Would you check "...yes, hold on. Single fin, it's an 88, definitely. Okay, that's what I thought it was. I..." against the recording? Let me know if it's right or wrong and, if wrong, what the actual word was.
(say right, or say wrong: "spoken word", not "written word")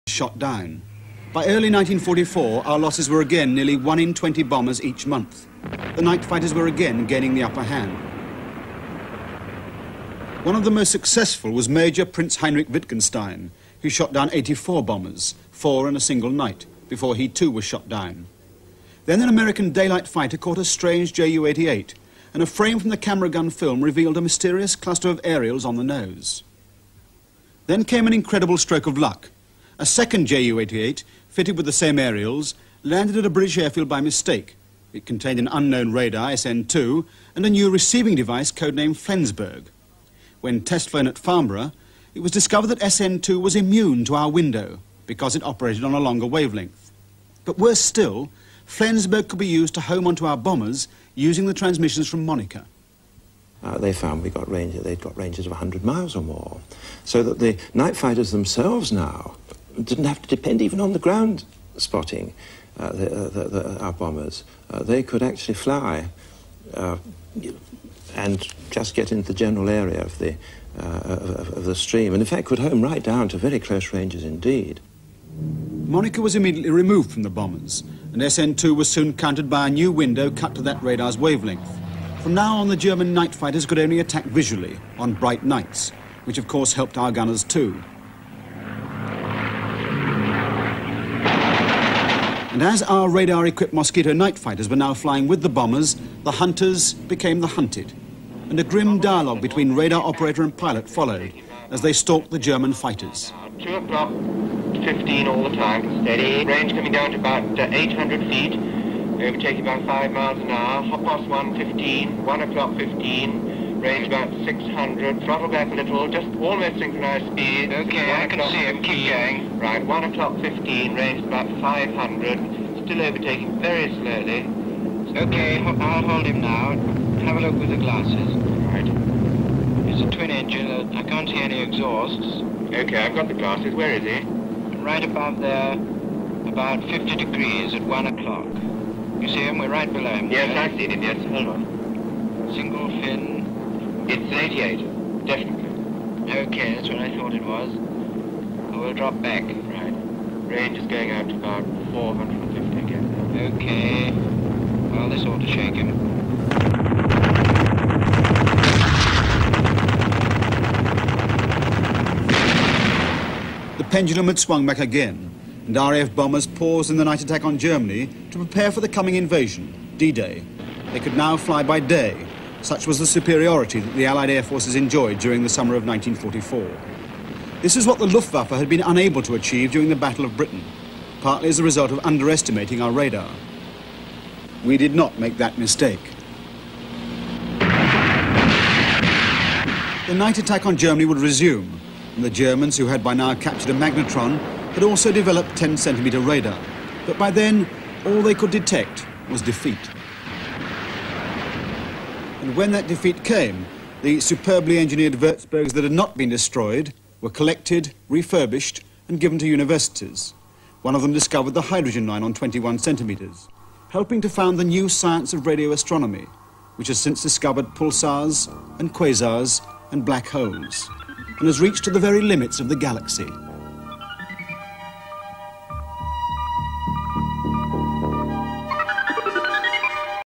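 right.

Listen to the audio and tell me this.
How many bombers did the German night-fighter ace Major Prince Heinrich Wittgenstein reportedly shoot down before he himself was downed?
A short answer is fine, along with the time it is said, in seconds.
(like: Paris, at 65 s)
84, at 14 s.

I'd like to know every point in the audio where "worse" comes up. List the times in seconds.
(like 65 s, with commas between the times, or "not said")
47 s.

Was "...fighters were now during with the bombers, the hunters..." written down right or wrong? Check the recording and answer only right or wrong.
wrong.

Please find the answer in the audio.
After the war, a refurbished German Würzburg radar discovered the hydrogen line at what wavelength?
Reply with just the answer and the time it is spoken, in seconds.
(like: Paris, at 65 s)
21 centimeters, at 212 s.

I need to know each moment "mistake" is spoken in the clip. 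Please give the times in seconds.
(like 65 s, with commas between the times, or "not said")
33 s, 185 s.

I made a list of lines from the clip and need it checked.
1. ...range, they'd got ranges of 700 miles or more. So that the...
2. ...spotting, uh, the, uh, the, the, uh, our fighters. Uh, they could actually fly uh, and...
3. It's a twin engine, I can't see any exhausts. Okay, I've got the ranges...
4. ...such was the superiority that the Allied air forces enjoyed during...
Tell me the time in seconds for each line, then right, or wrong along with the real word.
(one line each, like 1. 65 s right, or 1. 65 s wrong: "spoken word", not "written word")
1. 54 s wrong: "100", not "700"
2. 61 s wrong: "bombers", not "fighters"
3. 129 s wrong: "glasses", not "ranges"
4. 172 s right.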